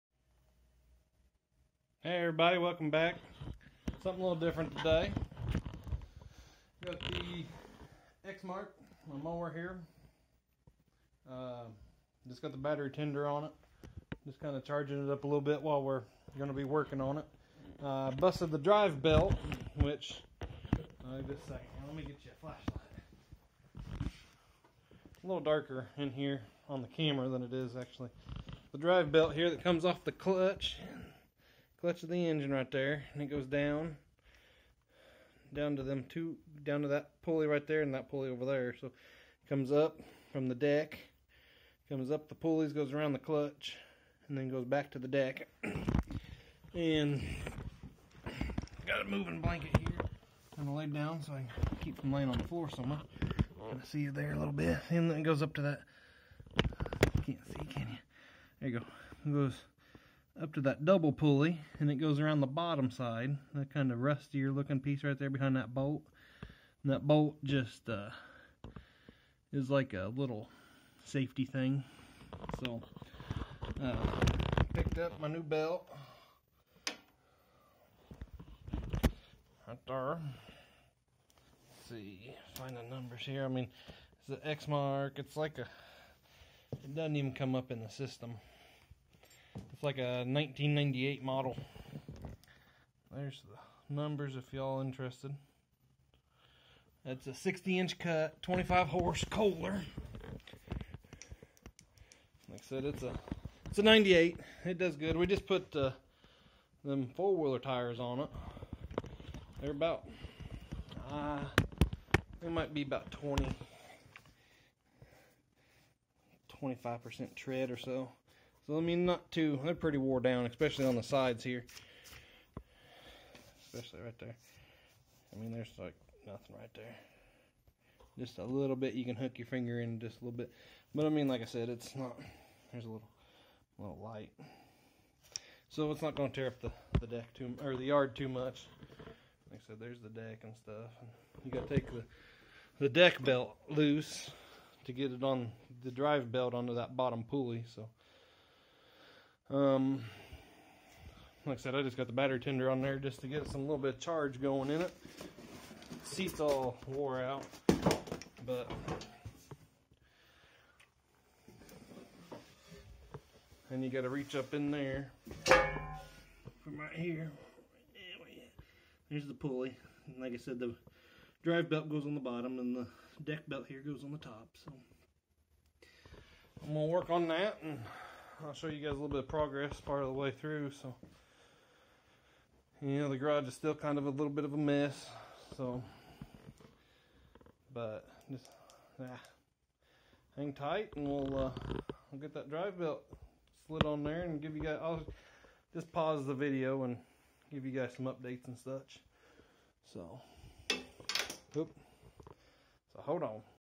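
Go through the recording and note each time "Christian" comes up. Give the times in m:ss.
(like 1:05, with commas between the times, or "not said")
not said.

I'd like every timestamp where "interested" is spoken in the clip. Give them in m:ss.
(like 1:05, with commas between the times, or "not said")
1:34.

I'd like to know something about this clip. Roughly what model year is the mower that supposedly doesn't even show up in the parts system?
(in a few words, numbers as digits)
1998.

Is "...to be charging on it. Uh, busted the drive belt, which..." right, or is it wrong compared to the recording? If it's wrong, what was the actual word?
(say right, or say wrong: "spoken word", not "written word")
wrong: "working", not "charging".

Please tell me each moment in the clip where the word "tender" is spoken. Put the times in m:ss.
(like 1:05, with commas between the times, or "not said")
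0:12, 2:32.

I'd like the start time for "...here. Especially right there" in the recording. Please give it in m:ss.
2:01.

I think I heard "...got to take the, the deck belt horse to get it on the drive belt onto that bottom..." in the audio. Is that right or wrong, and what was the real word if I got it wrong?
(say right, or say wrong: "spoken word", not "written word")
wrong: "loose", not "horse".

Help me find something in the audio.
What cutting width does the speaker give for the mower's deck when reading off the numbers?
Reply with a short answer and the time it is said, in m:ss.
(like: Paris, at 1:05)
60 inch, at 1:37.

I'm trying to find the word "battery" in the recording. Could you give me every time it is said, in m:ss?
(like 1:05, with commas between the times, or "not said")
0:12, 2:32.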